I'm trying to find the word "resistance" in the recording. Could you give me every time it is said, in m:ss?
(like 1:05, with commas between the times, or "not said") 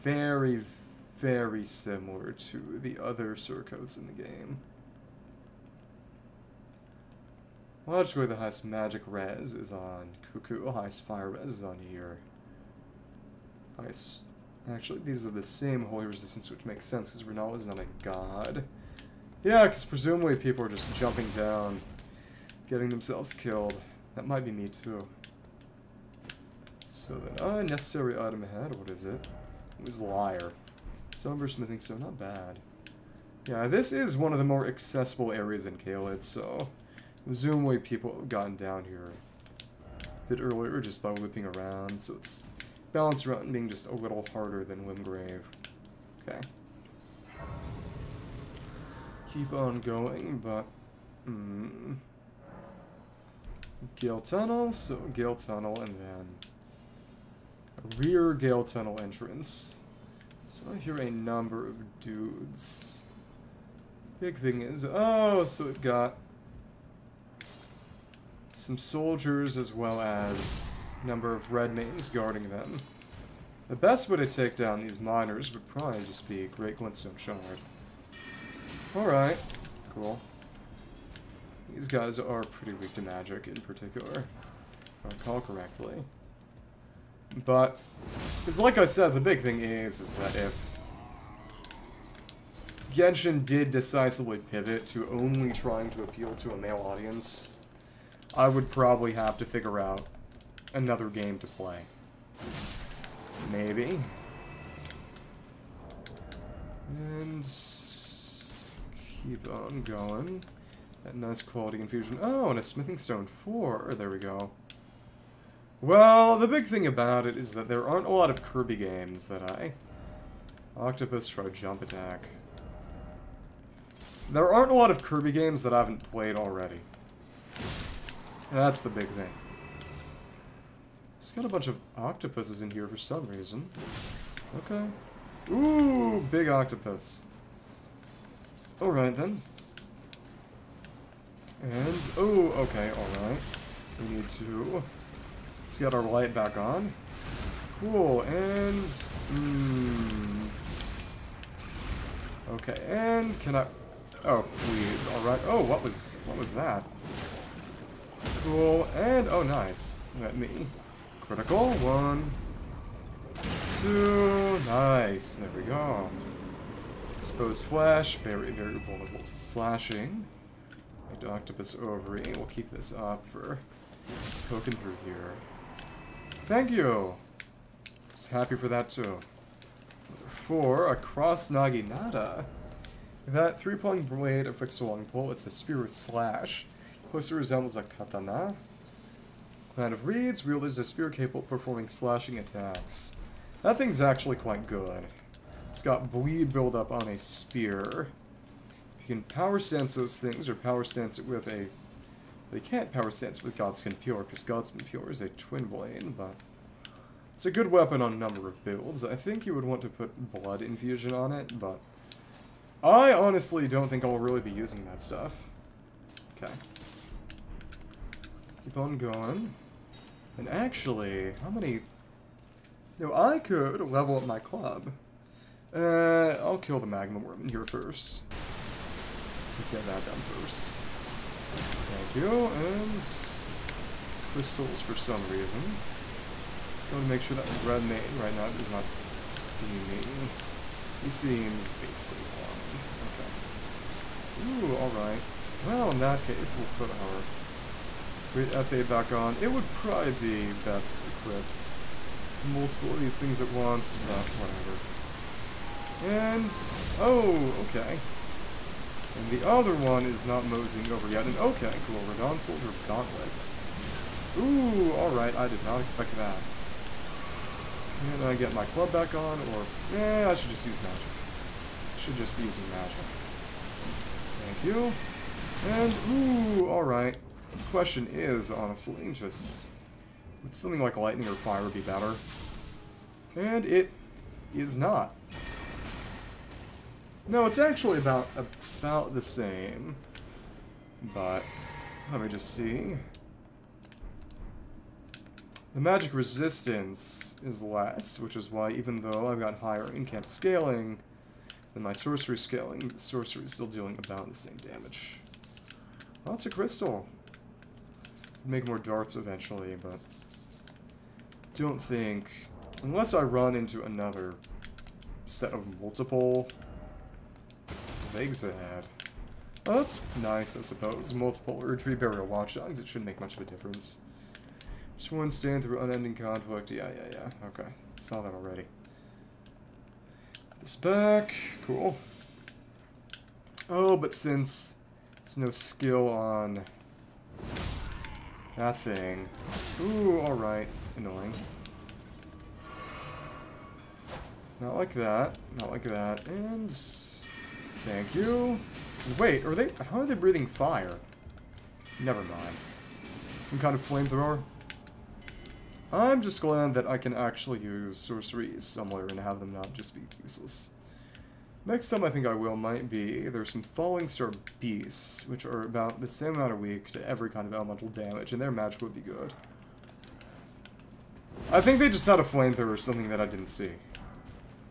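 0:16, 4:56.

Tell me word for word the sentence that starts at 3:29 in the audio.
I think you would want to put Blood Infusion on it, but...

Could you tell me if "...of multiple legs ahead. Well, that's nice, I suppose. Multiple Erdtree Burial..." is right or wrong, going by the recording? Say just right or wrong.
right.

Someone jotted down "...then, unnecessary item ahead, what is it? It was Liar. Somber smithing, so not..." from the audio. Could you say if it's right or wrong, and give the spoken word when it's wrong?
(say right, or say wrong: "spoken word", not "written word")
right.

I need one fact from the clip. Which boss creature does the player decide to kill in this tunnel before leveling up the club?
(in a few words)
Magma Wyrm.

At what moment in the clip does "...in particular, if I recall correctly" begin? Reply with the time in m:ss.
1:23.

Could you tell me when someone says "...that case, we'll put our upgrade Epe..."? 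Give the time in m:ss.
4:05.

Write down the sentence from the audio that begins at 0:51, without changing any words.
Mm, Gael Tunnel, so Gael Tunnel, and then rear Gael Tunnel entrance.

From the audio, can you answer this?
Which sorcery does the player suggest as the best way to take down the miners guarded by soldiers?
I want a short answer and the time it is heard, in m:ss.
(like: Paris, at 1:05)
Great Glintstone Shard, at 1:16.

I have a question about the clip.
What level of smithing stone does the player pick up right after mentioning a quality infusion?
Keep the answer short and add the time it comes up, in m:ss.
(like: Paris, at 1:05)
4, at 1:52.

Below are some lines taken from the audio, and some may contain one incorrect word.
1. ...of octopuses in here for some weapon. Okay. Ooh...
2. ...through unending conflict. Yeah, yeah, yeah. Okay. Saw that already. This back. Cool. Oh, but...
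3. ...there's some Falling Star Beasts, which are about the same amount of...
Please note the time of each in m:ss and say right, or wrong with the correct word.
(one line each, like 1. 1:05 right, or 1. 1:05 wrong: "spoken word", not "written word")
1. 2:11 wrong: "reason", not "weapon"
2. 5:25 right
3. 6:03 right.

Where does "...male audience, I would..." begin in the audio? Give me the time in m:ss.
1:36.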